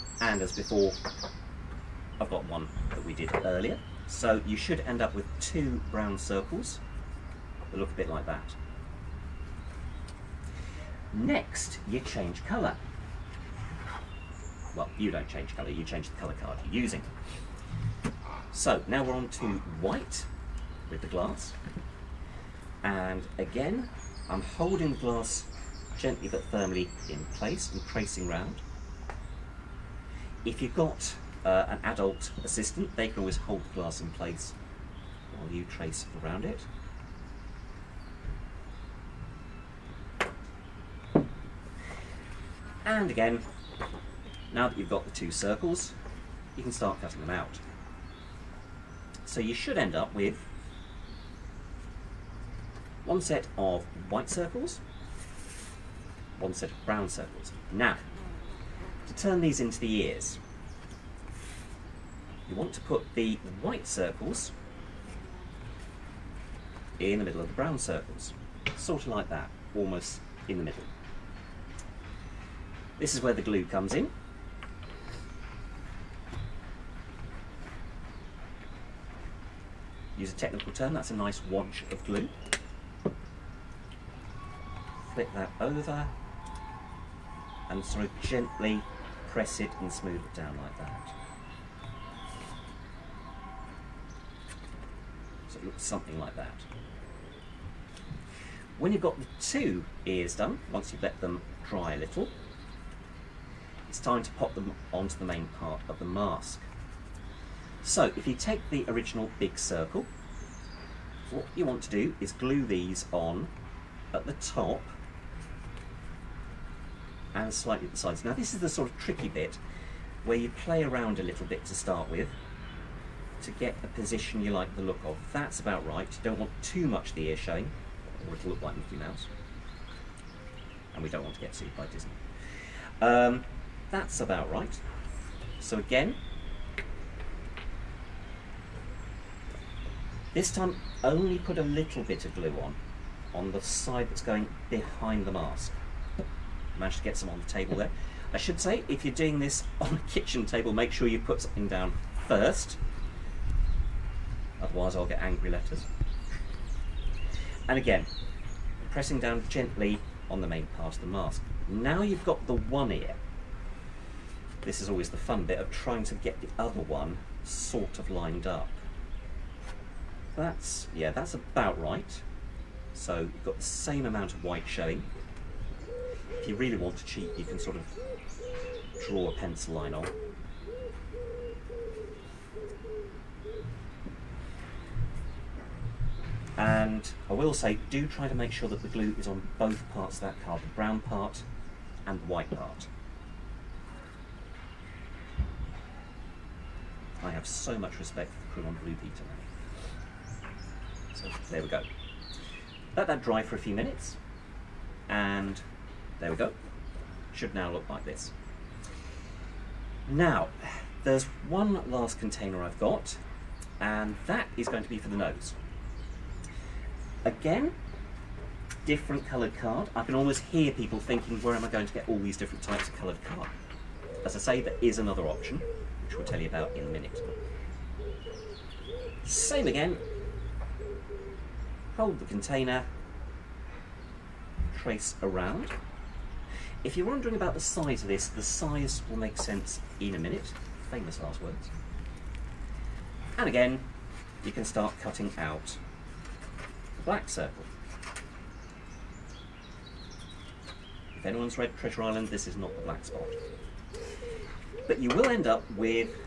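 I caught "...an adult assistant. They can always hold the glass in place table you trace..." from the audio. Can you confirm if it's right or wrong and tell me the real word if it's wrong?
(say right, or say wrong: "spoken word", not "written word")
wrong: "while", not "table".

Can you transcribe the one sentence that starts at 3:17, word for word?
I have so much respect for the on Blue Peter now.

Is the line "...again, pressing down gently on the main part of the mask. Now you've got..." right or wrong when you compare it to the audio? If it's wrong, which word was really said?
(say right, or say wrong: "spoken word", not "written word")
right.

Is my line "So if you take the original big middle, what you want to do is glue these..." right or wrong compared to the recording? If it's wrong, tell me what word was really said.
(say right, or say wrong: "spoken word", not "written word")
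wrong: "circle", not "middle".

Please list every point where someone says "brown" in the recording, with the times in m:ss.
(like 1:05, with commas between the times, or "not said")
0:05, 0:56, 1:07, 3:10.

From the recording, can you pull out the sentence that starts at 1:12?
This is where the glue comes in.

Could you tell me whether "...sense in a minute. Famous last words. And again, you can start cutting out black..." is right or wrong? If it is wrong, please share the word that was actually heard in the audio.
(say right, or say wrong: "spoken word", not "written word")
right.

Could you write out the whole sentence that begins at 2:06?
You don't want too much the ear showing, or it'll look like Mickey Mouse.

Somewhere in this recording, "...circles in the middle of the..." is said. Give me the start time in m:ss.
1:03.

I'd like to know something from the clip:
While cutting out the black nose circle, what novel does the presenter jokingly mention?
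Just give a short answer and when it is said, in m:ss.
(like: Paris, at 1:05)
Treasure Island, at 4:11.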